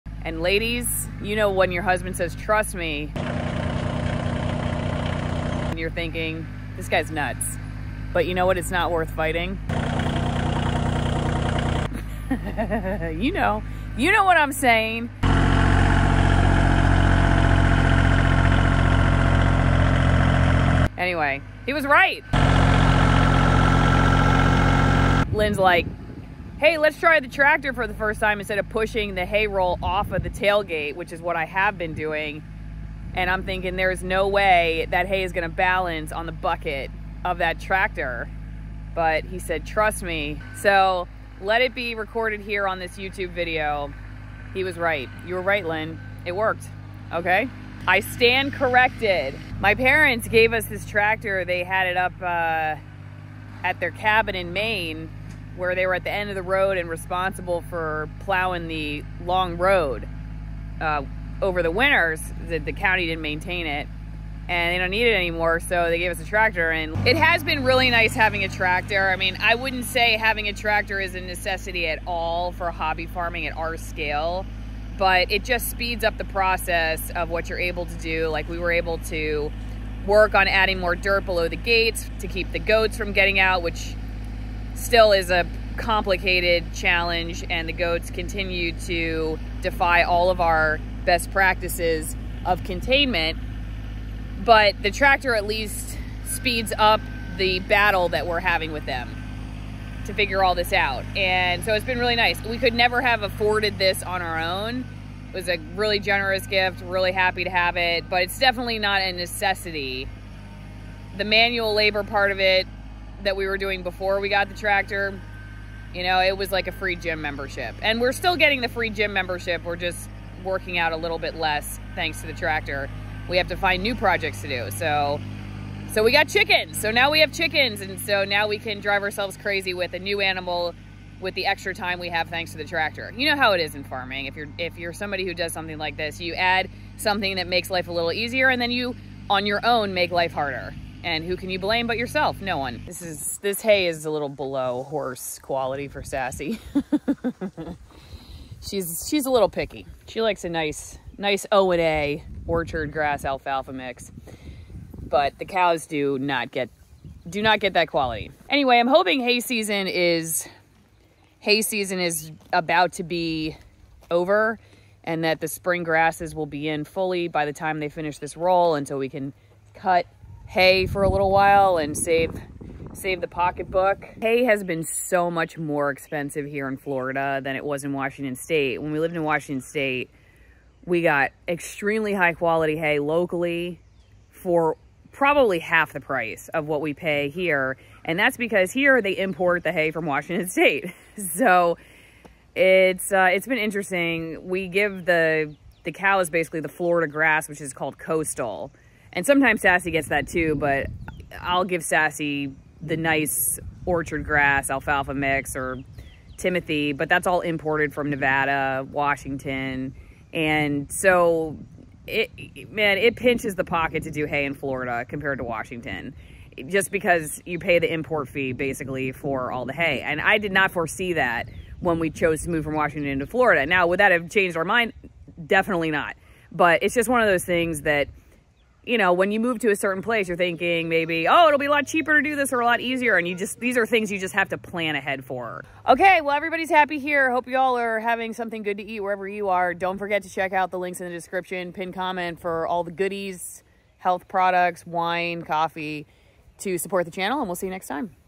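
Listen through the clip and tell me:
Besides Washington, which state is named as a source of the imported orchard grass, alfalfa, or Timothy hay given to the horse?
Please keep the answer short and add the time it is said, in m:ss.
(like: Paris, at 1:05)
Nevada, at 3:28.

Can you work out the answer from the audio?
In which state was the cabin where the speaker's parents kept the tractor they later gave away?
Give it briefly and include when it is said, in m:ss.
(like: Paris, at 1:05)
Maine, at 0:54.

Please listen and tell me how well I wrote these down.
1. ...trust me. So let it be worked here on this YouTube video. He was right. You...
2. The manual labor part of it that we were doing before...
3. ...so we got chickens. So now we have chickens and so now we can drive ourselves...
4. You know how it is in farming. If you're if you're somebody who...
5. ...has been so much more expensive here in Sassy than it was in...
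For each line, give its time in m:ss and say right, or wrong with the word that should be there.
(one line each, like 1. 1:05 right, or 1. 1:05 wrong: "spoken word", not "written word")
1. 0:39 wrong: "recorded", not "worked"
2. 1:51 right
3. 2:05 right
4. 2:13 right
5. 2:54 wrong: "Florida", not "Sassy".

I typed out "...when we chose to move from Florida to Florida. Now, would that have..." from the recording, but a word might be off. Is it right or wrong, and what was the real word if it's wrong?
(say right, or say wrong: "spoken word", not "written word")
wrong: "Washington", not "Florida".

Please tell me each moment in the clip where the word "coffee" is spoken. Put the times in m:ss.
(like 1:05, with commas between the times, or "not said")
4:05.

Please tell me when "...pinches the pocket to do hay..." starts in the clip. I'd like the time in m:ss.
3:33.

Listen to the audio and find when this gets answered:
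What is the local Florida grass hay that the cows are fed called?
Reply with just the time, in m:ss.
3:17.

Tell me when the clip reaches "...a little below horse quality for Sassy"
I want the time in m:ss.
2:24.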